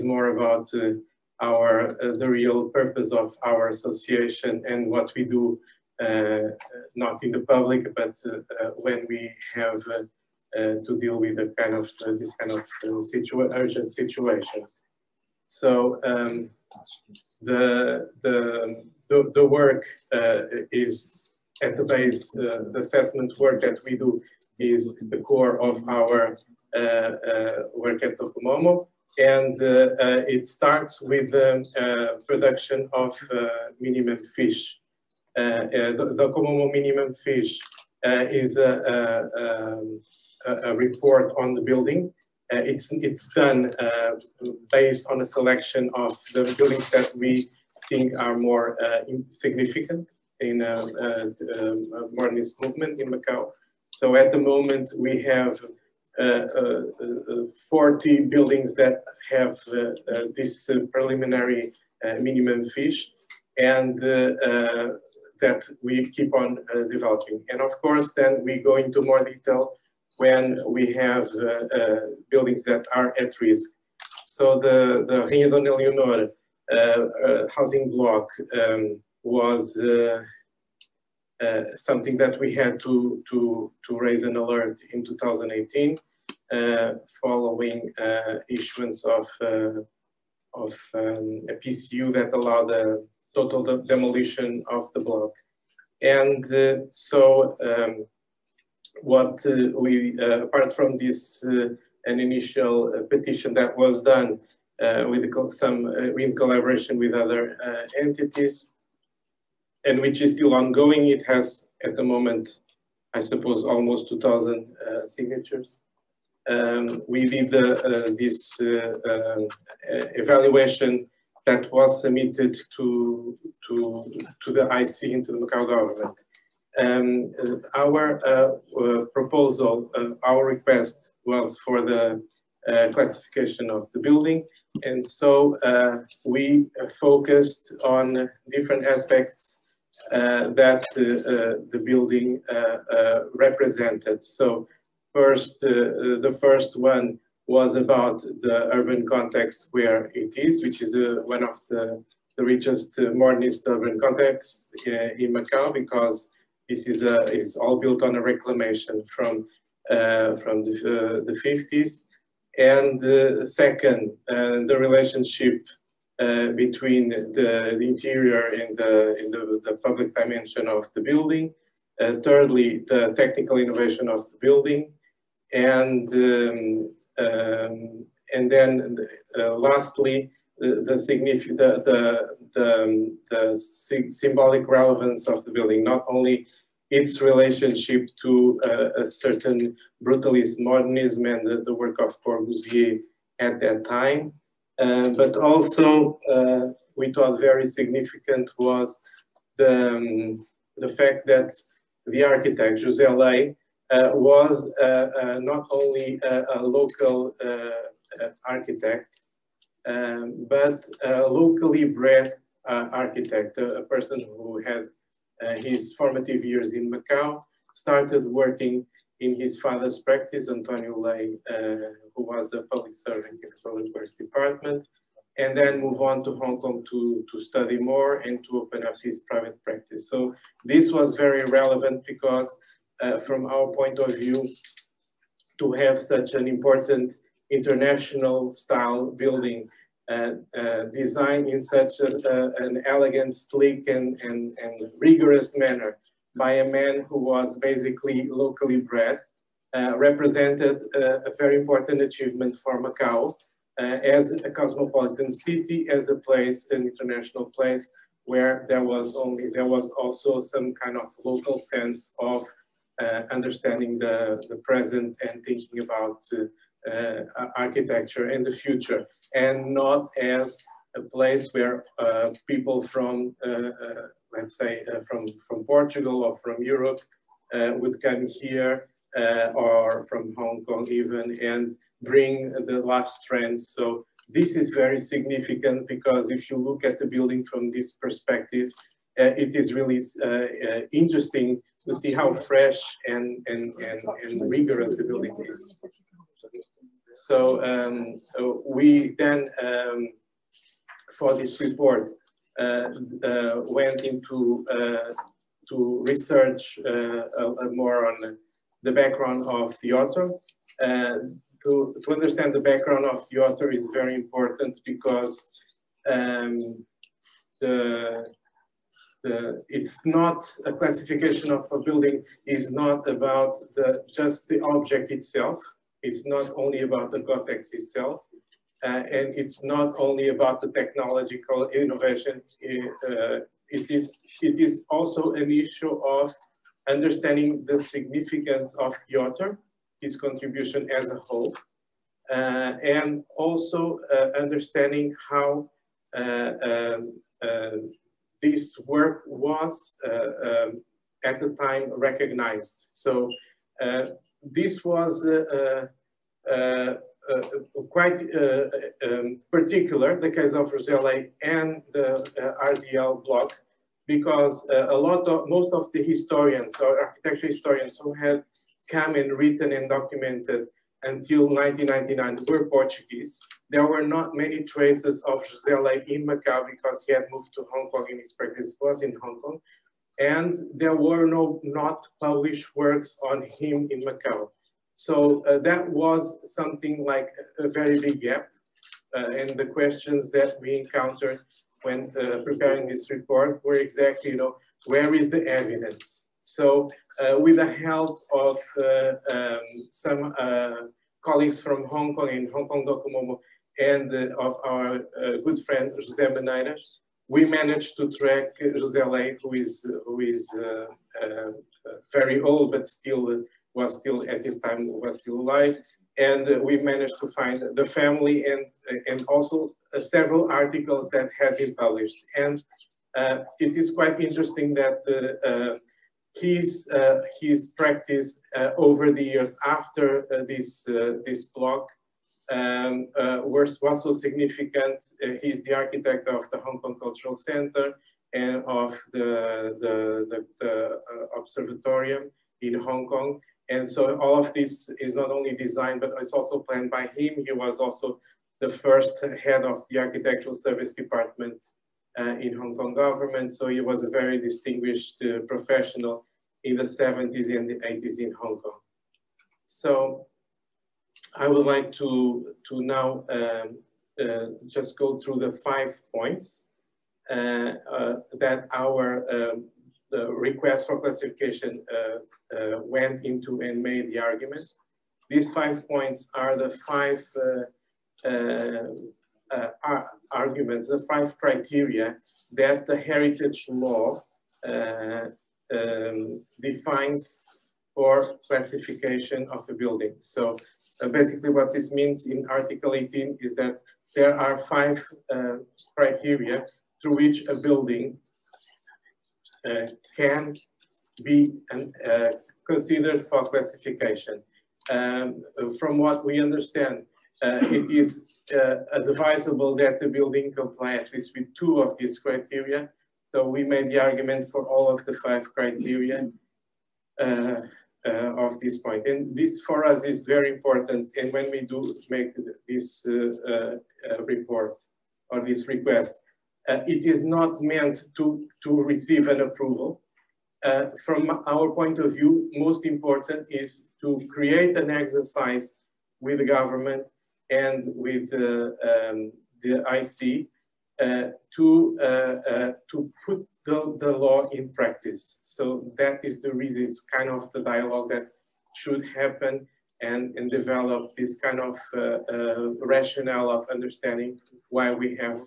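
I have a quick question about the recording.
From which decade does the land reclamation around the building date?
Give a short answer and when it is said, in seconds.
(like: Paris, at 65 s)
the 50s, at 161 s.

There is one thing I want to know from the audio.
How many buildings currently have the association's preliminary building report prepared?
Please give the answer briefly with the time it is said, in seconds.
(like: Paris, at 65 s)
40, at 57 s.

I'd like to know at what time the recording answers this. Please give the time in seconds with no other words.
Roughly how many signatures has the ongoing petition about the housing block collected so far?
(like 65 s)
113 s.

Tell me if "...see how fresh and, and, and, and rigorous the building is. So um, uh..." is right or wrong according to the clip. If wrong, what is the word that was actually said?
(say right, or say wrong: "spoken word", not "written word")
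right.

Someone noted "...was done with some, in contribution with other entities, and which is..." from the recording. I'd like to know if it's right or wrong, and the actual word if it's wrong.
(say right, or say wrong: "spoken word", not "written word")
wrong: "collaboration", not "contribution".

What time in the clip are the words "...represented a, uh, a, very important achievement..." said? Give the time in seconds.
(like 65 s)
249 s.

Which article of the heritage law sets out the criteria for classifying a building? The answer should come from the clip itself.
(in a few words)
Article 18.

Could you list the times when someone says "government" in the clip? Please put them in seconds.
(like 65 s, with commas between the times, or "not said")
125 s, 452 s, 536 s.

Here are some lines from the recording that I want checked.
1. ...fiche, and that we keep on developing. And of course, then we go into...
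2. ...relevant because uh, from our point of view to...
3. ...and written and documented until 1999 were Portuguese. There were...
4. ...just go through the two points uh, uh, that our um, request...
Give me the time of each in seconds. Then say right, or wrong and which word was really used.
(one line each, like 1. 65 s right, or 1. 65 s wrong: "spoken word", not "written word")
1. 62 s right
2. 231 s right
3. 369 s right
4. 464 s wrong: "five", not "two".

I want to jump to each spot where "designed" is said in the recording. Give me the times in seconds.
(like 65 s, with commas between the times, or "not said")
240 s, 445 s.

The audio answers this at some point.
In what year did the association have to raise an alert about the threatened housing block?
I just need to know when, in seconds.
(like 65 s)
85 s.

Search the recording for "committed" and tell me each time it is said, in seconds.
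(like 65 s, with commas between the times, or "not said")
not said.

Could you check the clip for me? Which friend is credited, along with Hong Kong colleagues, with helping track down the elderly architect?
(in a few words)
José Benítez.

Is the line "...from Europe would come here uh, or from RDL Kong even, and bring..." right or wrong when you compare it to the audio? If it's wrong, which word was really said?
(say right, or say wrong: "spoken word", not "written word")
wrong: "Hong", not "RDL".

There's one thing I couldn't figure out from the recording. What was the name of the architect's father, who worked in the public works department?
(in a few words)
Antonio Lei.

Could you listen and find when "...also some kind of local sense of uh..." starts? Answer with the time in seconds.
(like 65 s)
259 s.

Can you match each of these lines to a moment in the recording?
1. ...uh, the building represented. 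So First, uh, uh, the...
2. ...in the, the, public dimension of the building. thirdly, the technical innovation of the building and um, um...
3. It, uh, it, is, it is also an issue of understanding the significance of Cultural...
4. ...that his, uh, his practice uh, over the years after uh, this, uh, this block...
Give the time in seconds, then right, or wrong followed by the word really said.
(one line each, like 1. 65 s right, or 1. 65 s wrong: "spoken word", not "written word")
1. 141 s right
2. 169 s right
3. 332 s wrong: "Piotr", not "Cultural"
4. 424 s right.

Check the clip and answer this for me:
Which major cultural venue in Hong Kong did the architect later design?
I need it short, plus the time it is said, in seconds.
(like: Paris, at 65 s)
Hong Kong Cultural Center, at 436 s.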